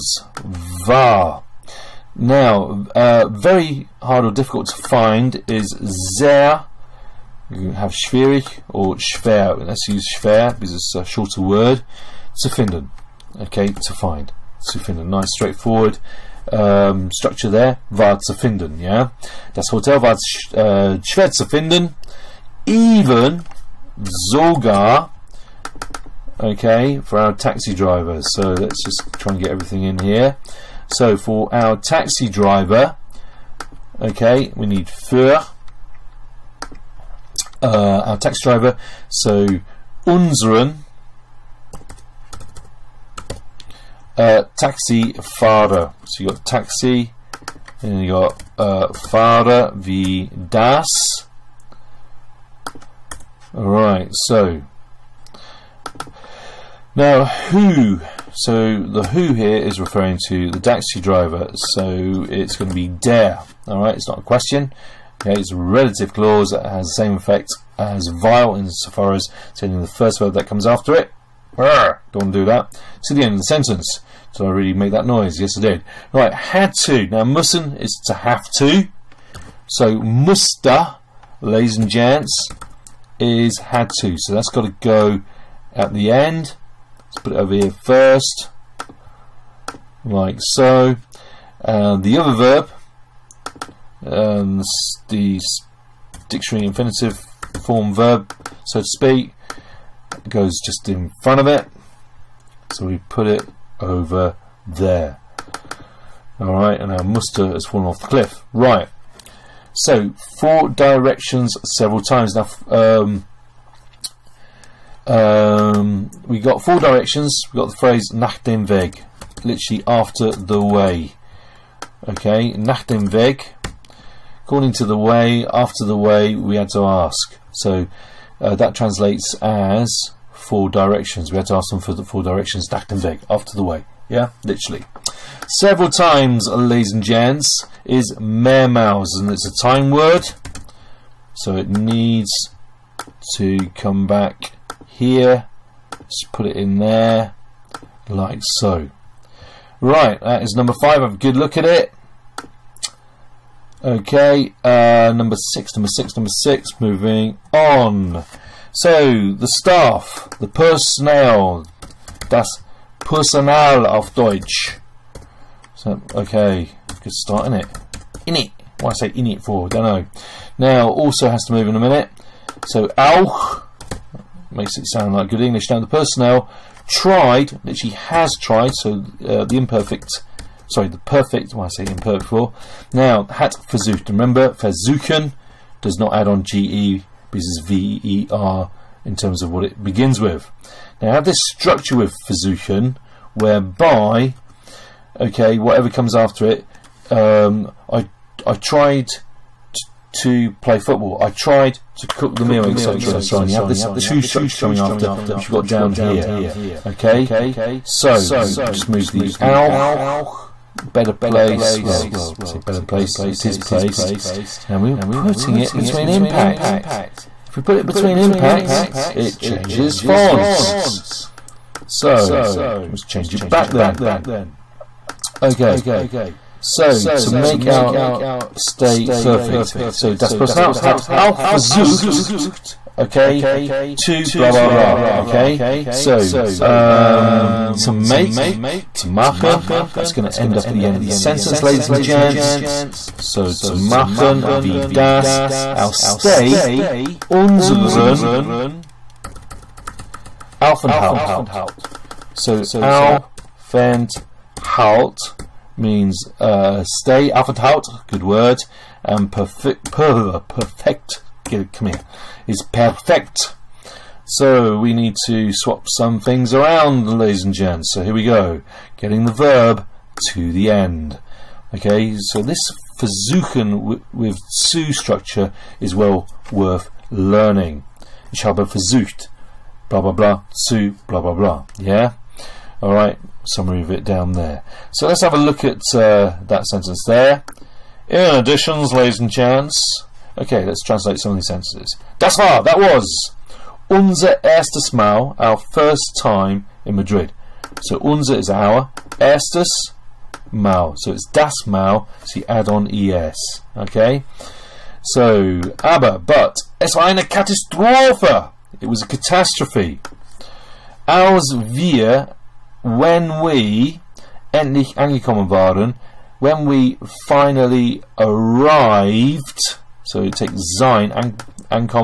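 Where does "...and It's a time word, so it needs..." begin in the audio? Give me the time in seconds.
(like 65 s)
138 s.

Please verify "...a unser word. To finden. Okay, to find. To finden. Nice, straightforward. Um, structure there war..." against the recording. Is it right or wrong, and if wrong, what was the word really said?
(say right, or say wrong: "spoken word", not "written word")
wrong: "shorter", not "unser".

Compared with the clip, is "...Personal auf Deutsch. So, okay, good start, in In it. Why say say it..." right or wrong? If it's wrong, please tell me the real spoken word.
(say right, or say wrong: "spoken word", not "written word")
right.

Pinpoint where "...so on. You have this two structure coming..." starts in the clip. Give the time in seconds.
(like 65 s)
203 s.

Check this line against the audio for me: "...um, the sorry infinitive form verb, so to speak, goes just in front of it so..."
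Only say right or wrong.
wrong.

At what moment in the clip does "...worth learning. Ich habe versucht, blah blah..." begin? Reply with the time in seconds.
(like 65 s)
276 s.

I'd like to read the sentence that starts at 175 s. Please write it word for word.
Now, the personnel tried, literally has tried, so uh, the imperfect sorry, the perfect, why I say imperfect for.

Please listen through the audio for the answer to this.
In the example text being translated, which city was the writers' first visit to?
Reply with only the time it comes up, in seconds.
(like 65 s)
295 s.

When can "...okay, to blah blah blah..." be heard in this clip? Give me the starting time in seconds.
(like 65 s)
232 s.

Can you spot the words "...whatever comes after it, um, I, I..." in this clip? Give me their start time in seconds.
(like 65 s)
195 s.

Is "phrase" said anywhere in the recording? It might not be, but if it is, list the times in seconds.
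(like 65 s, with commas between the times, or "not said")
117 s.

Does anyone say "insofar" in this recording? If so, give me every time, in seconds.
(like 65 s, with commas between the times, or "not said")
68 s.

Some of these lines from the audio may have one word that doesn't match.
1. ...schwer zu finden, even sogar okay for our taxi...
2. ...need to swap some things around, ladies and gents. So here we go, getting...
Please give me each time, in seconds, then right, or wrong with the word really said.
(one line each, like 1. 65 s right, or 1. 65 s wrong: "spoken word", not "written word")
1. 21 s right
2. 264 s right.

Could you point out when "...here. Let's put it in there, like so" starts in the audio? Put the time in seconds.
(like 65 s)
144 s.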